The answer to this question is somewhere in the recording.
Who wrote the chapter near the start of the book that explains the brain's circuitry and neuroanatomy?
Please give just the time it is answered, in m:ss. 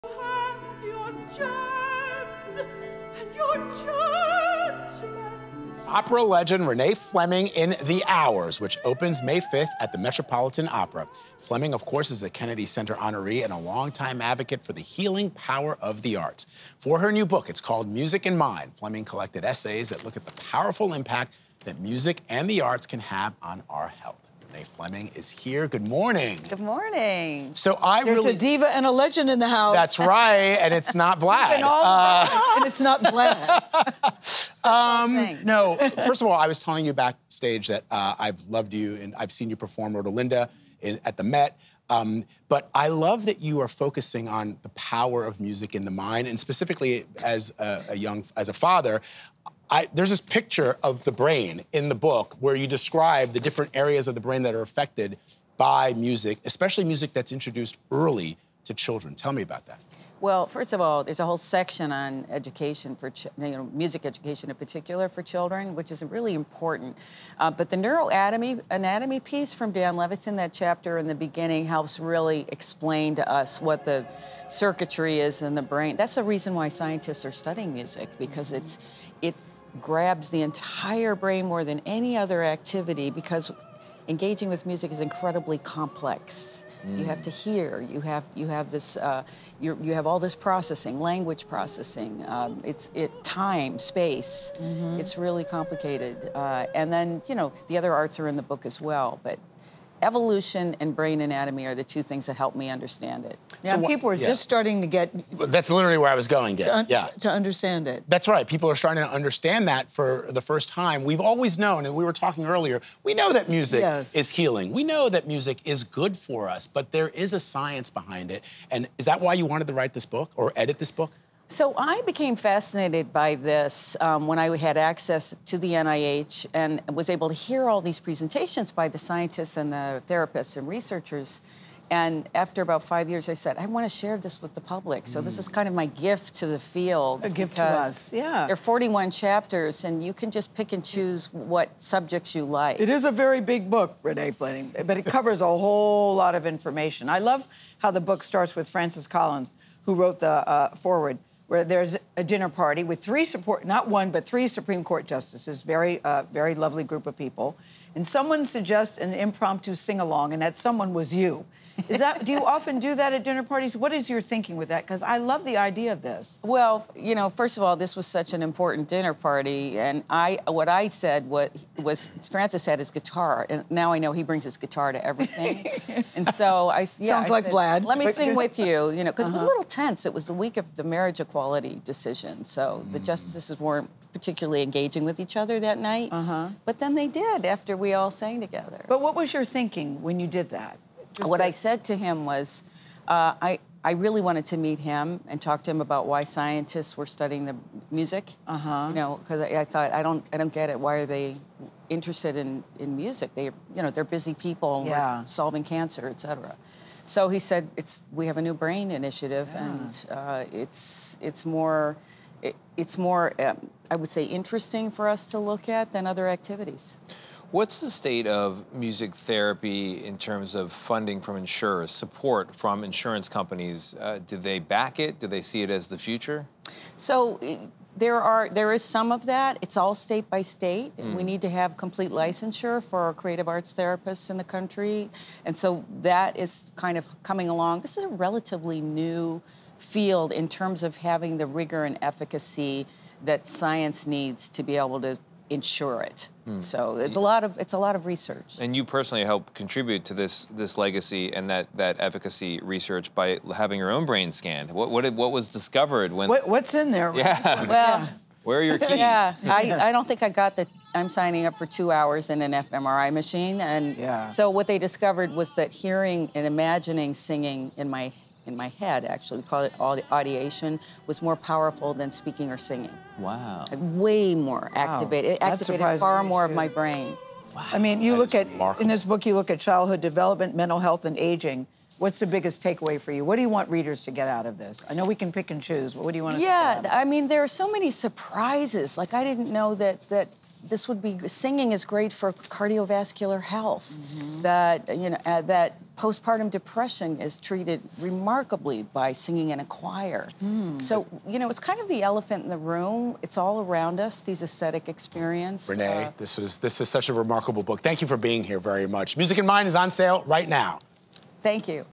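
1:09.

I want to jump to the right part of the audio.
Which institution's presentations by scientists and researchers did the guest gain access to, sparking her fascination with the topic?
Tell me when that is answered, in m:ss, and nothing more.
2:05.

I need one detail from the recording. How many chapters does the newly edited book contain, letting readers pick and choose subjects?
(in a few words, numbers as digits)
41.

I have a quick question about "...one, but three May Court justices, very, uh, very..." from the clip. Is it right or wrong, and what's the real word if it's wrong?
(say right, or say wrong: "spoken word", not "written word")
wrong: "Supreme", not "May".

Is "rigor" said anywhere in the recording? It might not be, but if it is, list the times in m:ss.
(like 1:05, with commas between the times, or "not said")
4:01.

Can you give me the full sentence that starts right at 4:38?
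in this book, you look at childhood development, mental health, and aging.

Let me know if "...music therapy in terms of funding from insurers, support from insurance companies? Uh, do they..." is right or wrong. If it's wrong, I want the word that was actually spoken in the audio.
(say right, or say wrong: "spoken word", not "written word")
right.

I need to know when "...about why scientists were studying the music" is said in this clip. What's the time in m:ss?
3:15.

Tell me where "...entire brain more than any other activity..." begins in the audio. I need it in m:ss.
1:20.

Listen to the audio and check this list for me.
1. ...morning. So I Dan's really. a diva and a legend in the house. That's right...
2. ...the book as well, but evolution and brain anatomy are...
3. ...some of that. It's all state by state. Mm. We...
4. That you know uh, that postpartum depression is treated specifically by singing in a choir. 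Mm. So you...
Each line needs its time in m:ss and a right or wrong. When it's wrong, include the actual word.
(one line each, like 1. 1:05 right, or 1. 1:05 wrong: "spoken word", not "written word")
1. 0:26 wrong: "There", not "Dan"
2. 1:38 right
3. 3:48 right
4. 4:54 wrong: "remarkably", not "specifically".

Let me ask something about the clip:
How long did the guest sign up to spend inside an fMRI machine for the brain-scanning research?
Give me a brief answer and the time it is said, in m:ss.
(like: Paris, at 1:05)
2 hours, at 4:21.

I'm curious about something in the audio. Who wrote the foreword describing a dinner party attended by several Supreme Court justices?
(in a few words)
Francis Collins.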